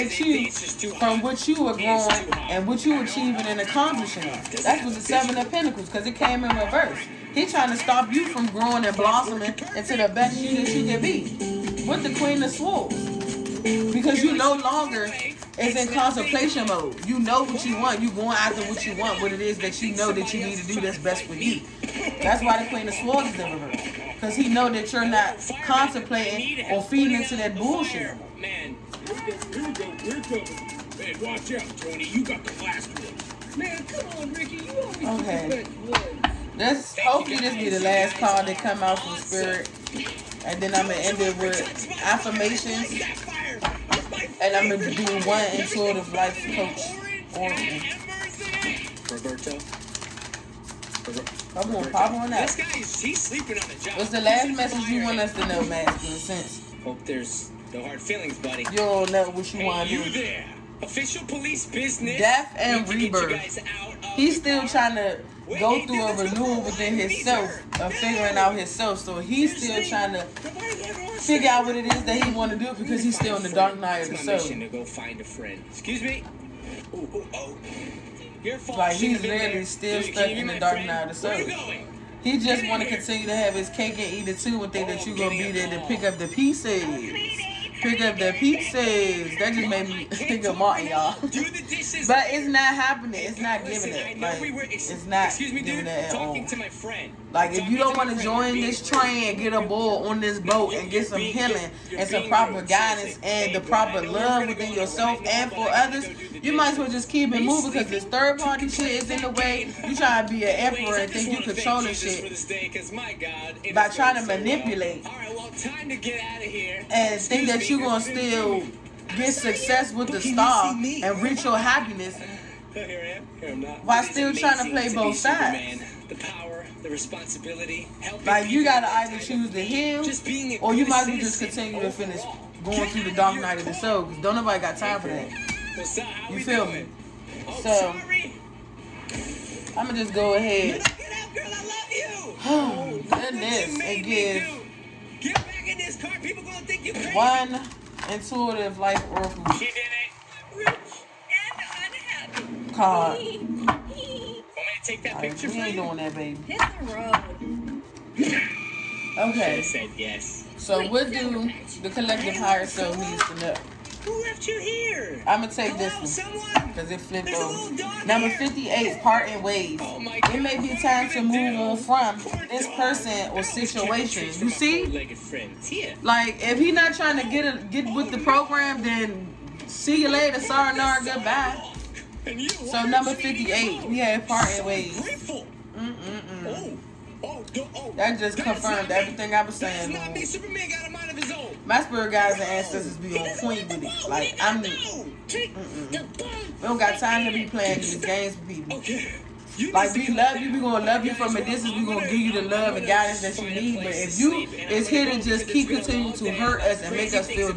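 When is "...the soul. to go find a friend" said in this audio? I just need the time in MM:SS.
01:14.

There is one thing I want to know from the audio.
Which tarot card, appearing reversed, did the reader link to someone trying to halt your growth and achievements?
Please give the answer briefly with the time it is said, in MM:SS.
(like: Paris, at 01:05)
Seven of Pentacles, at 00:05.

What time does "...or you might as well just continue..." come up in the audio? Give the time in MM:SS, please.
02:10.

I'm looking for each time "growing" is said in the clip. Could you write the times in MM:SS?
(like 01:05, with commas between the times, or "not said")
00:01, 00:08.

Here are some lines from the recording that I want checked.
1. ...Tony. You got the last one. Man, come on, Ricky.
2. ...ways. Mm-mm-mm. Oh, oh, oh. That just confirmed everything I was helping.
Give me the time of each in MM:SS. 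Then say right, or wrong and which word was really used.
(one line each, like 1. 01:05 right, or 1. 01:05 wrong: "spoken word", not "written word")
1. 00:31 right
2. 03:04 wrong: "saying", not "helping".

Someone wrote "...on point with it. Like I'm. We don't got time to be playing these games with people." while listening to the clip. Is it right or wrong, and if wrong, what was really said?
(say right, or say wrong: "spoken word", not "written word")
right.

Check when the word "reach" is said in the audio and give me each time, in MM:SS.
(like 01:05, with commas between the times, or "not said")
02:01.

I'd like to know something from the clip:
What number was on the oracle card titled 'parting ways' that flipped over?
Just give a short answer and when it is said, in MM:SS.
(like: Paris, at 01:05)
58, at 02:48.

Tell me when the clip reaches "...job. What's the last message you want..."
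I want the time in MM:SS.
00:53.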